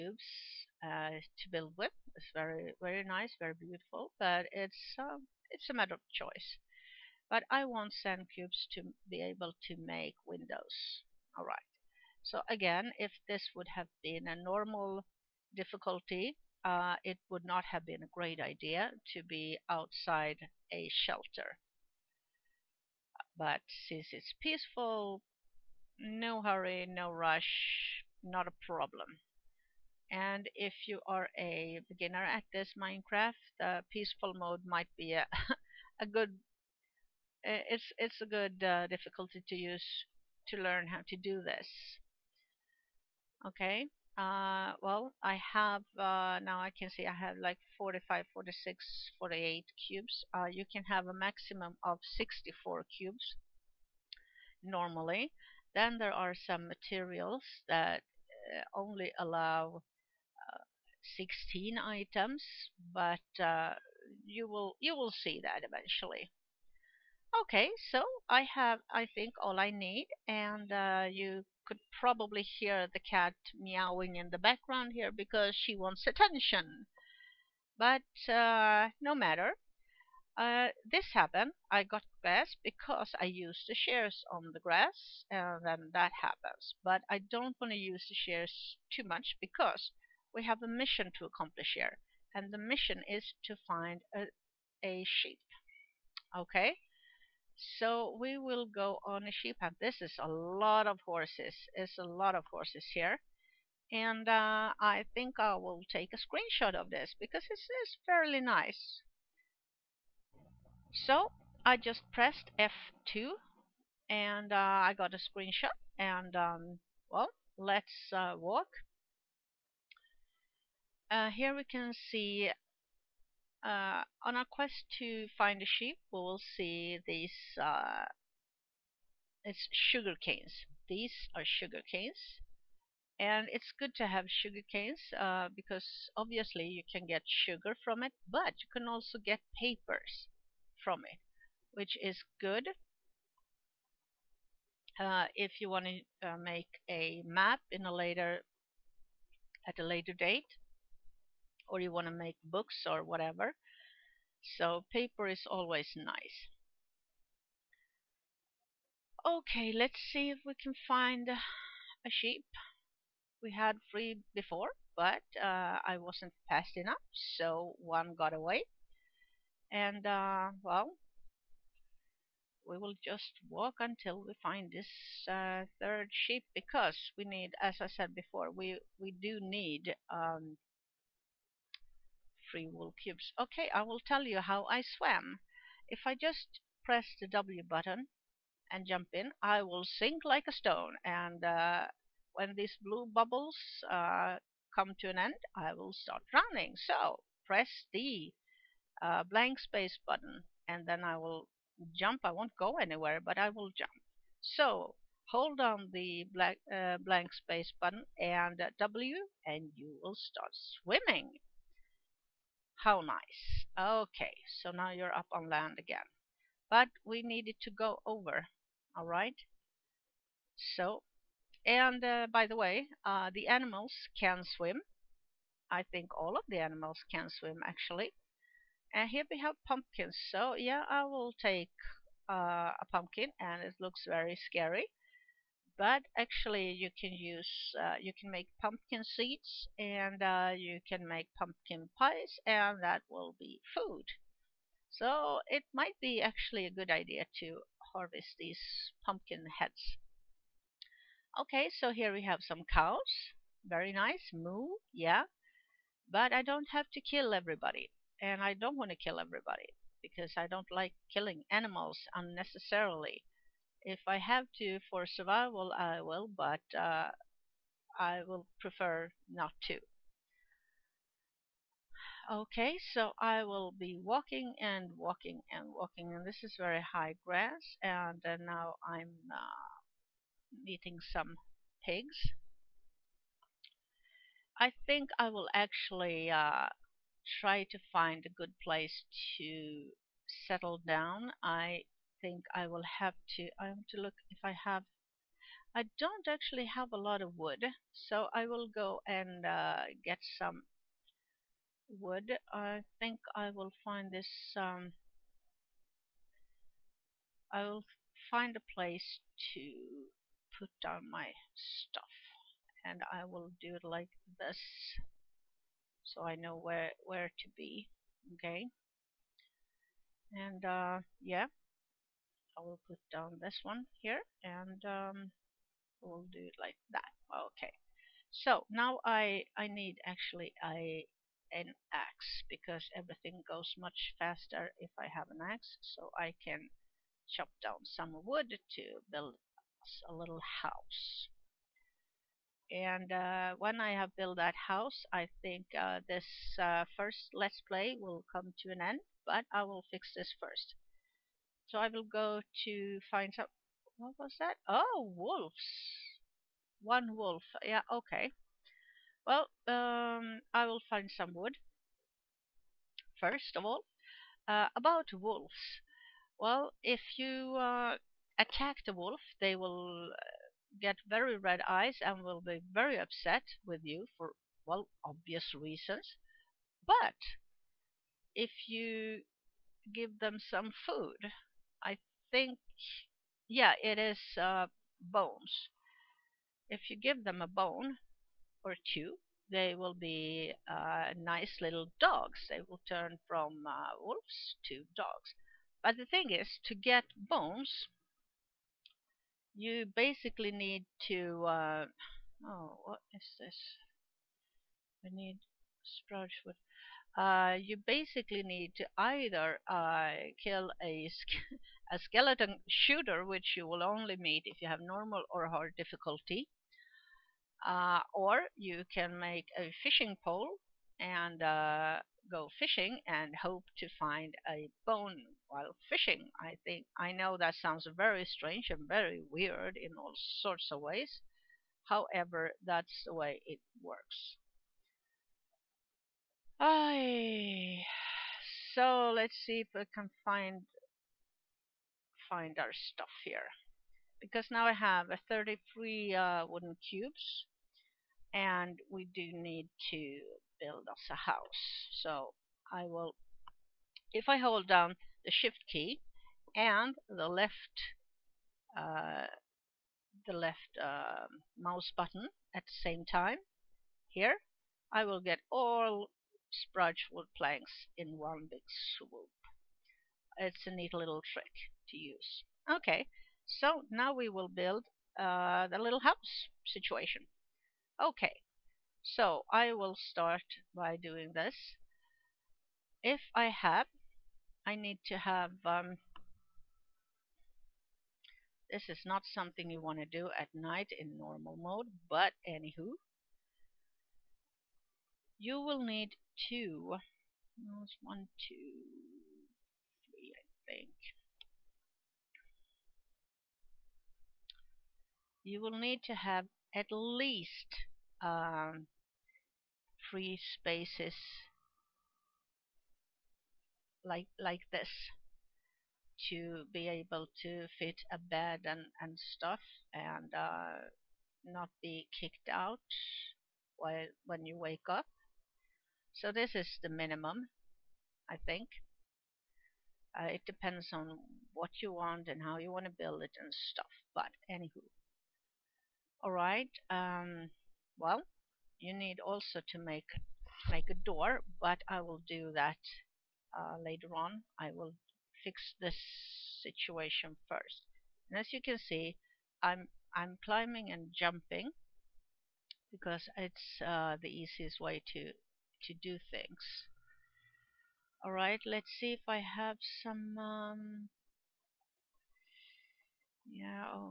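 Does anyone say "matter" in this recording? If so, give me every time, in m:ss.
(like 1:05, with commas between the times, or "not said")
0:05, 1:19.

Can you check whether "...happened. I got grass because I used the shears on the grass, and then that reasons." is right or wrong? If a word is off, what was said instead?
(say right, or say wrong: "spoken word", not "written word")
wrong: "happens", not "reasons".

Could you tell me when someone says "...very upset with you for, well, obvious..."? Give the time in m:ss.
6:12.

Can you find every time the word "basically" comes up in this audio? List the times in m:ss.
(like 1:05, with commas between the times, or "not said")
6:39, 6:47.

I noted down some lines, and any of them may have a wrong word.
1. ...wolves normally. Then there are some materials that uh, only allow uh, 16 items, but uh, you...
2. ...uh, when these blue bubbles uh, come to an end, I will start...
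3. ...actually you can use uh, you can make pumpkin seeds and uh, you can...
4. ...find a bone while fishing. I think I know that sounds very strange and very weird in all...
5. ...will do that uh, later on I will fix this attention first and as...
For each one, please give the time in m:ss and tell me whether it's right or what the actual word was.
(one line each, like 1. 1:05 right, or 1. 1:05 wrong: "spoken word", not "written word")
1. 0:52 wrong: "cubes", not "wolves"
2. 3:11 right
3. 3:56 right
4. 7:03 right
5. 9:02 wrong: "situation", not "attention".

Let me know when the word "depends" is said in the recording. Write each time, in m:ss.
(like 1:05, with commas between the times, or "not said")
8:50.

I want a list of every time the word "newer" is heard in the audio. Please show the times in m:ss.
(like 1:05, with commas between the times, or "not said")
not said.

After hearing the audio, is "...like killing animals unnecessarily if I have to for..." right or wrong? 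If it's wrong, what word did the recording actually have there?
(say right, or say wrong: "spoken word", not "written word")
right.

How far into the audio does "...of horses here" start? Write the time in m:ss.
1:42.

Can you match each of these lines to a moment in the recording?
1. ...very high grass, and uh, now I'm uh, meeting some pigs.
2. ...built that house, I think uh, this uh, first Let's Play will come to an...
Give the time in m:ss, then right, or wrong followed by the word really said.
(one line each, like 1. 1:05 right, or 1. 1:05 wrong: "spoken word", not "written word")
1. 4:36 right
2. 5:44 right.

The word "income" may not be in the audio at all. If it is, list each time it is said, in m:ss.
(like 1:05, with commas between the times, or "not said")
not said.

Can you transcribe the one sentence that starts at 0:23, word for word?
But since it's peaceful, no hurry, no rush, not a problem.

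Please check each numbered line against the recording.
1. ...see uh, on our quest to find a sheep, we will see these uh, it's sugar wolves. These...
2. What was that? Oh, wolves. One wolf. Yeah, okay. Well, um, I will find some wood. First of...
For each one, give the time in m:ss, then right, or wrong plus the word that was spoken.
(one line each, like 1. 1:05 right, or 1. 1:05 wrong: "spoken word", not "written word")
1. 2:02 wrong: "canes", not "wolves"
2. 5:53 right.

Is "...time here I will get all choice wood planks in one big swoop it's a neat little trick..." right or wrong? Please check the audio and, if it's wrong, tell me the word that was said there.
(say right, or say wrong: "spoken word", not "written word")
wrong: "spruce", not "choice".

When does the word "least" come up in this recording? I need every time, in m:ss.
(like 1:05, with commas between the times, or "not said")
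8:26.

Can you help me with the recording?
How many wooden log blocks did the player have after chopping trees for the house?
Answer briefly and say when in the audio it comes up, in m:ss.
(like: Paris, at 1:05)
33, at 7:25.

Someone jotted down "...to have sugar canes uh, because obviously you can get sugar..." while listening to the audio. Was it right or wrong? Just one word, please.
right.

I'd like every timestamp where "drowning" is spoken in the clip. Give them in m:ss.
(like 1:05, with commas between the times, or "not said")
3:16.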